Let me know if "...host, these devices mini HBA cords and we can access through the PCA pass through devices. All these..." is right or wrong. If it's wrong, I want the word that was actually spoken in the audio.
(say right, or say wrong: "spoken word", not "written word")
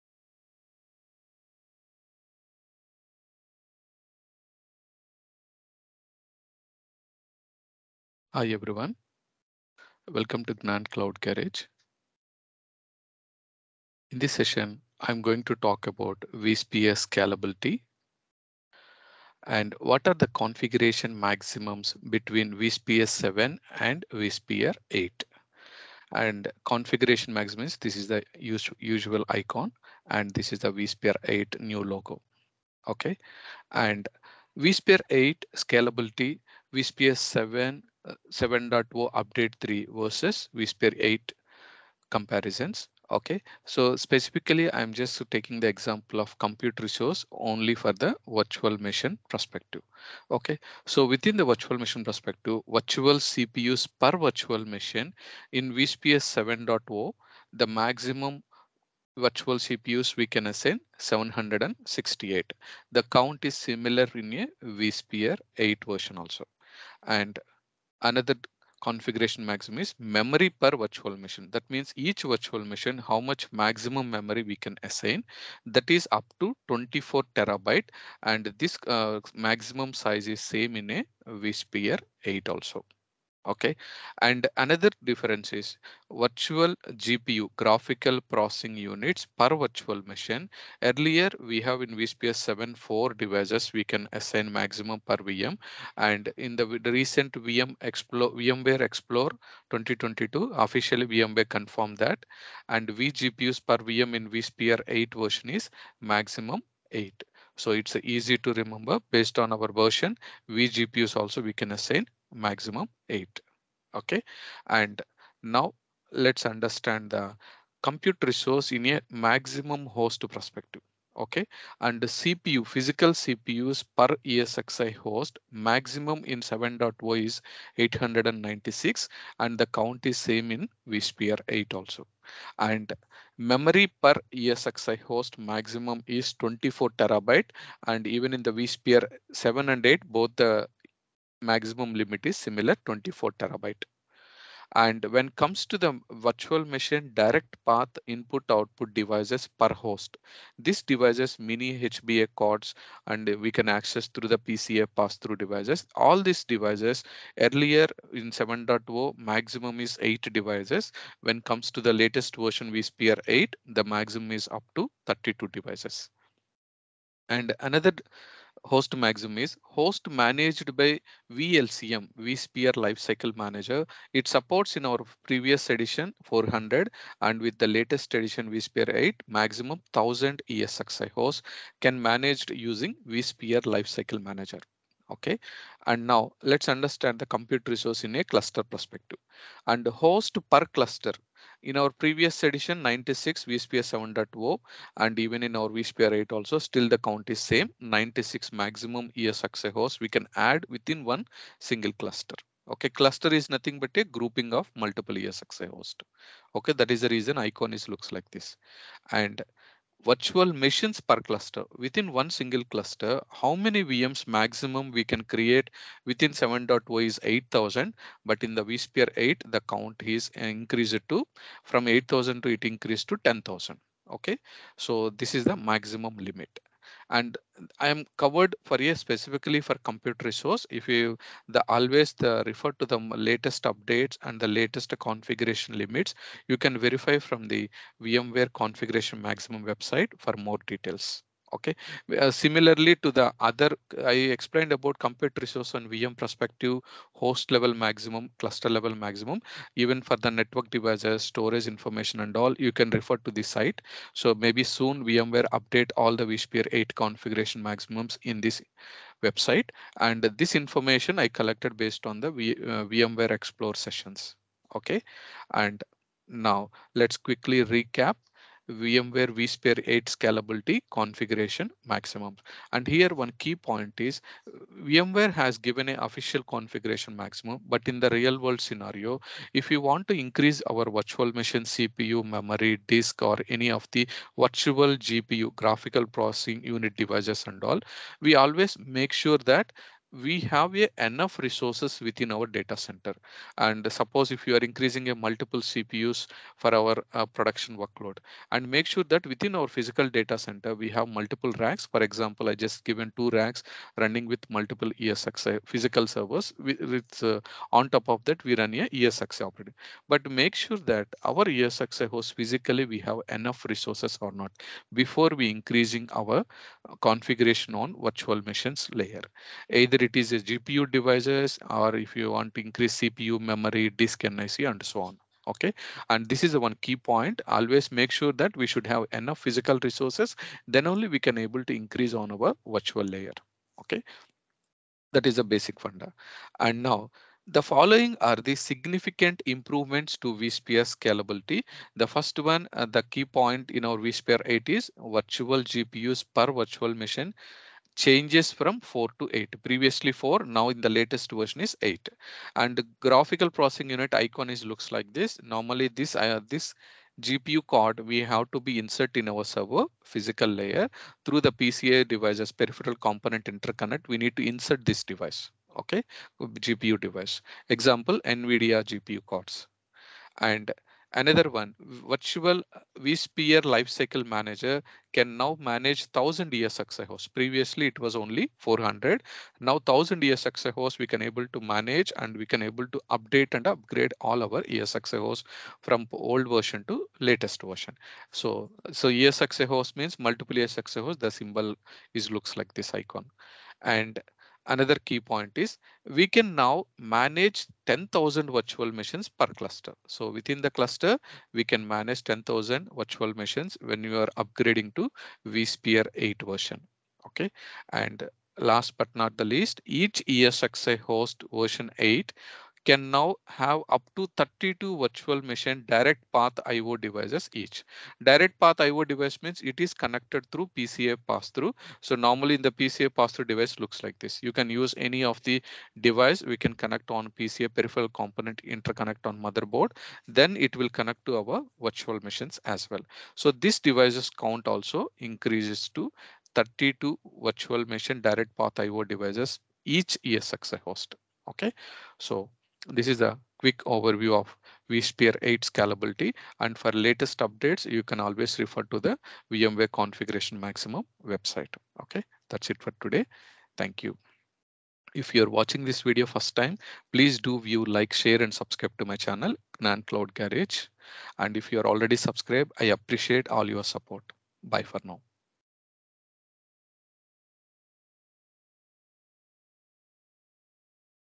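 right.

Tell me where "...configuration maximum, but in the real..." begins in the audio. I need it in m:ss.
4:36.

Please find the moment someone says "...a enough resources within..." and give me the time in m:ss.
4:50.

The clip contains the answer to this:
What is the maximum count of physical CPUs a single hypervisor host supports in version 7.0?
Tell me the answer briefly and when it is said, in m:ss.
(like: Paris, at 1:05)
896, at 2:07.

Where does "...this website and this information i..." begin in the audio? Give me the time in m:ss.
4:18.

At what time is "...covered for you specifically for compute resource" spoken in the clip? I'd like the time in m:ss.
3:48.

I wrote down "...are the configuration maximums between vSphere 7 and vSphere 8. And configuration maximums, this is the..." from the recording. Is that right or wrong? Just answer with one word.
right.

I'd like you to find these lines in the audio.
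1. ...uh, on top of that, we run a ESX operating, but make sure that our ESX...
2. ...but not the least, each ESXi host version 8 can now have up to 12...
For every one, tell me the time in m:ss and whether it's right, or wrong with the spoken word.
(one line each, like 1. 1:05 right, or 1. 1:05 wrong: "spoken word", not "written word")
1. 5:07 right
2. 6:48 wrong: "32", not "12".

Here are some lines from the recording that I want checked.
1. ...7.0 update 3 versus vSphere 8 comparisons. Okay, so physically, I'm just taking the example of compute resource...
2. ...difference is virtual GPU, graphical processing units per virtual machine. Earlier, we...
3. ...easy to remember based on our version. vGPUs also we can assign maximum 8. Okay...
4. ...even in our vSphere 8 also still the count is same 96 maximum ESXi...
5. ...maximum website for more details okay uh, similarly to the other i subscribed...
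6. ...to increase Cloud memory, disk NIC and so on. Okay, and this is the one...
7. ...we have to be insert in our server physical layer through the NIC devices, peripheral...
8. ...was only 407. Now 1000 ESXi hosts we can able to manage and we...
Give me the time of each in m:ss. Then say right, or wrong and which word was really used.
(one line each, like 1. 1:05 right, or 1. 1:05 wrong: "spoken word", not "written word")
1. 0:38 wrong: "specifically", not "physically"
2. 1:25 right
3. 1:48 right
4. 3:15 right
5. 3:59 wrong: "explained", not "subscribed"
6. 5:22 wrong: "CPU", not "Cloud"
7. 5:57 wrong: "PCA", not "NIC"
8. 6:17 wrong: "400", not "407".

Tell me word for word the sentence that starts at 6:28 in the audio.
So, so ESXi hosts means multiple ESXi hosts.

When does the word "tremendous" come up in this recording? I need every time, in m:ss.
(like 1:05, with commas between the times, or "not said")
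not said.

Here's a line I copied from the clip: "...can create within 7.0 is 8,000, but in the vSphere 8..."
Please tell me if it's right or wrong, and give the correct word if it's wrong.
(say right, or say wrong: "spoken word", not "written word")
right.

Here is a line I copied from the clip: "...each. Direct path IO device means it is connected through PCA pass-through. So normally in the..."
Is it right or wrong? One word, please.
right.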